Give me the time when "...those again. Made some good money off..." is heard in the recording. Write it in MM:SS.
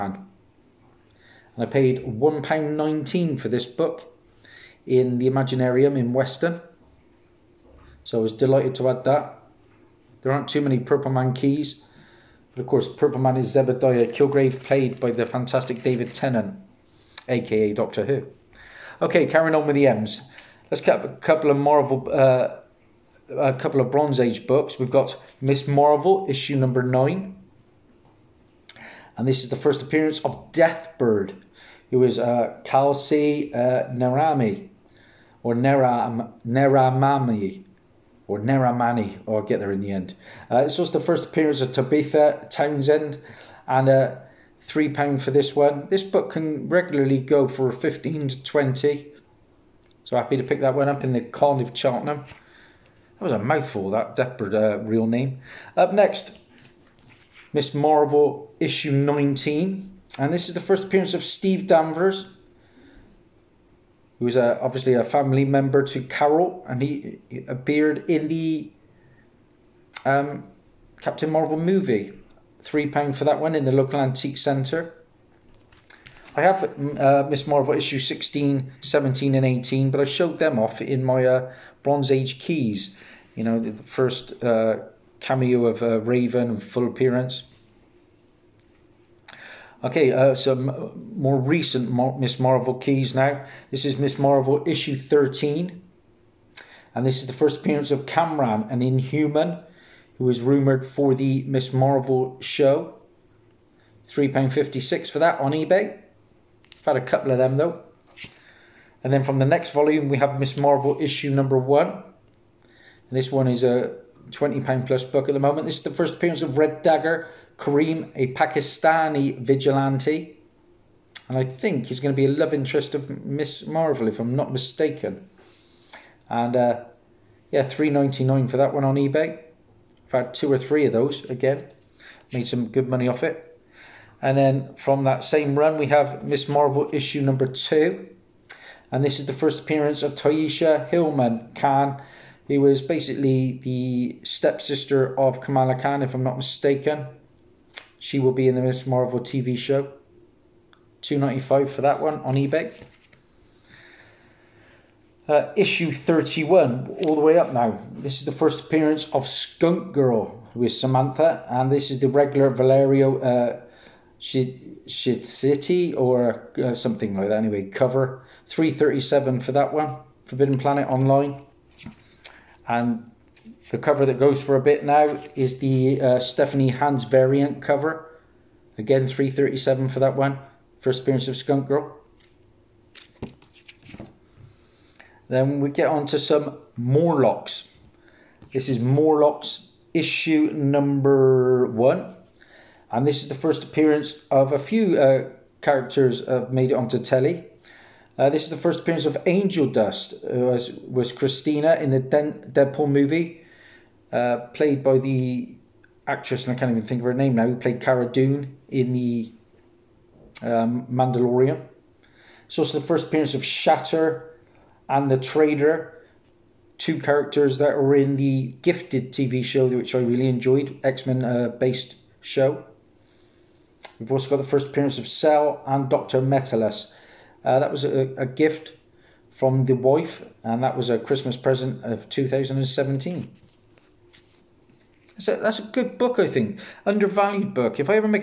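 02:10.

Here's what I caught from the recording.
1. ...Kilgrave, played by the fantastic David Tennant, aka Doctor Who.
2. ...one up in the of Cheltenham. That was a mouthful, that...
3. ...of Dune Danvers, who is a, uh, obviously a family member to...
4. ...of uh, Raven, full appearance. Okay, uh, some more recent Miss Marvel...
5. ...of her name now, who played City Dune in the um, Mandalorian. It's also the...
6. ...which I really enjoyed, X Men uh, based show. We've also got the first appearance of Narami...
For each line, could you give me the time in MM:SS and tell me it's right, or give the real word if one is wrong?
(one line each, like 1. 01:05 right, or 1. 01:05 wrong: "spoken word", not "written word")
1. 00:14 right
2. 00:50 right
3. 01:01 wrong: "Steve", not "Dune"
4. 01:25 right
5. 03:27 wrong: "Cara", not "City"
6. 03:39 wrong: "Cell", not "Narami".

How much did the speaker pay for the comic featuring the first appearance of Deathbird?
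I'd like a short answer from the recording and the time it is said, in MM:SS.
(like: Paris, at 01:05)
£3, at 00:44.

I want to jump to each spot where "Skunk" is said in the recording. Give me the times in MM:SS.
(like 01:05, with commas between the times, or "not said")
02:39, 03:01.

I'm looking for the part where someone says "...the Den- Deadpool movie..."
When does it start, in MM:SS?
03:21.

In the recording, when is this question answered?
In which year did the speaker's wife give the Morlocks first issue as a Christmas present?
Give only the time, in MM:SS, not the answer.
03:52.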